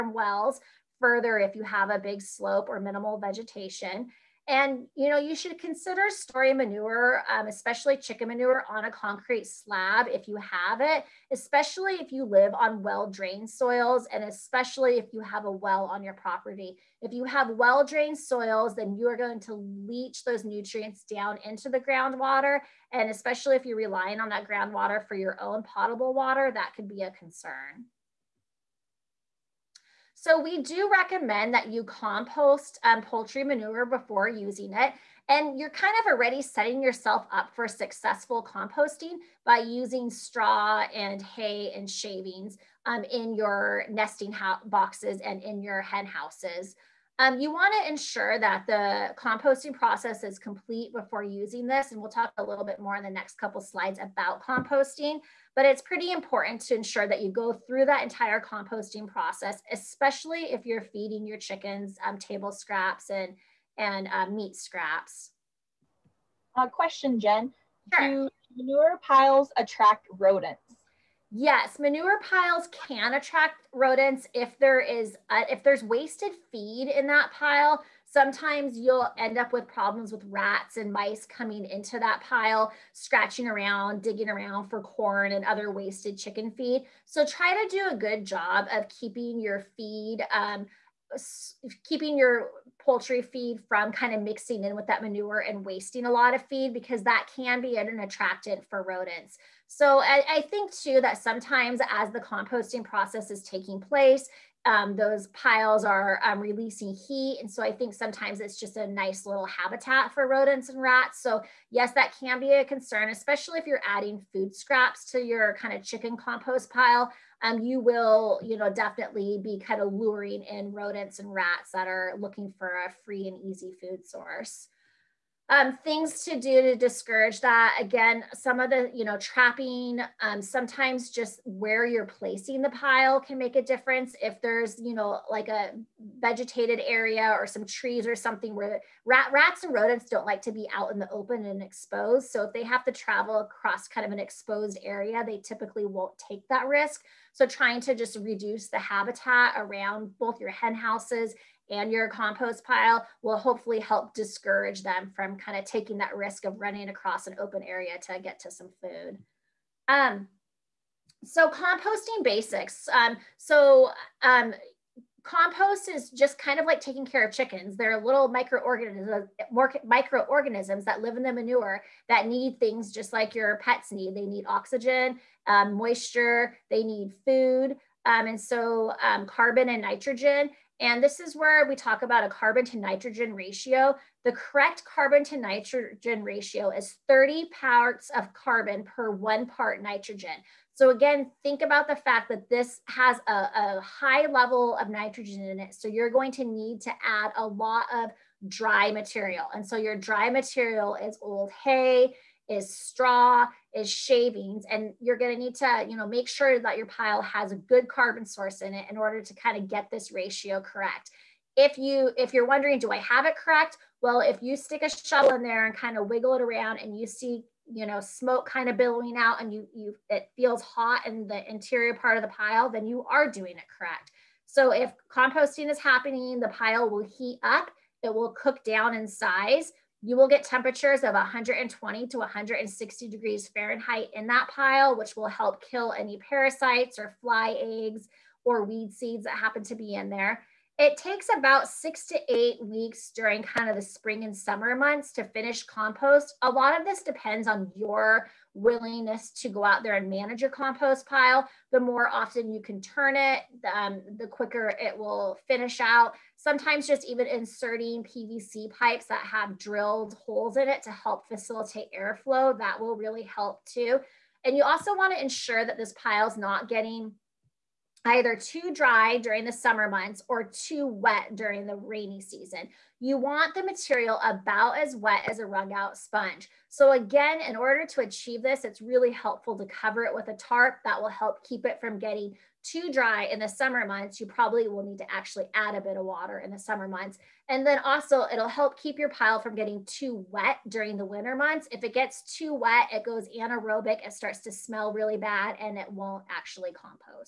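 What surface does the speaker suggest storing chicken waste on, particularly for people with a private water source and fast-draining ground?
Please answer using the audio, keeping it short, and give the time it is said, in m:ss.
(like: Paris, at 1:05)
concrete slab, at 0:08.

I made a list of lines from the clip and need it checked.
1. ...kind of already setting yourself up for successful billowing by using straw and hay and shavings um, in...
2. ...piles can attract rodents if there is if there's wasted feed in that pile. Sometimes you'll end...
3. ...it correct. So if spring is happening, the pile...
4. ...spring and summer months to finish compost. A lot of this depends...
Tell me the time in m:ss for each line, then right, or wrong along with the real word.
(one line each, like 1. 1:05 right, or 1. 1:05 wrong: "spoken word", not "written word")
1. 0:35 wrong: "composting", not "billowing"
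2. 1:12 right
3. 3:43 wrong: "composting", not "spring"
4. 4:03 right.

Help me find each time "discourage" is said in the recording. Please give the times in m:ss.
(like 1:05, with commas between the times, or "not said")
2:06, 2:34.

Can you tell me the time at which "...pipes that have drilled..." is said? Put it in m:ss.
4:18.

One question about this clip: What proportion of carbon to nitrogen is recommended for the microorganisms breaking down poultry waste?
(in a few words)
30 to 1.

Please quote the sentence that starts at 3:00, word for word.
And this is where we talk about a carbon to nitrogen ratio.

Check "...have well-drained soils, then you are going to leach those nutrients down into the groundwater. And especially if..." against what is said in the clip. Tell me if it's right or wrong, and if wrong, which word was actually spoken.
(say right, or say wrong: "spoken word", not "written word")
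right.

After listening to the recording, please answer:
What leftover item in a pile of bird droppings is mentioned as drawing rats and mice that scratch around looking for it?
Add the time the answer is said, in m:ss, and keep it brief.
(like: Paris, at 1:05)
corn, at 1:24.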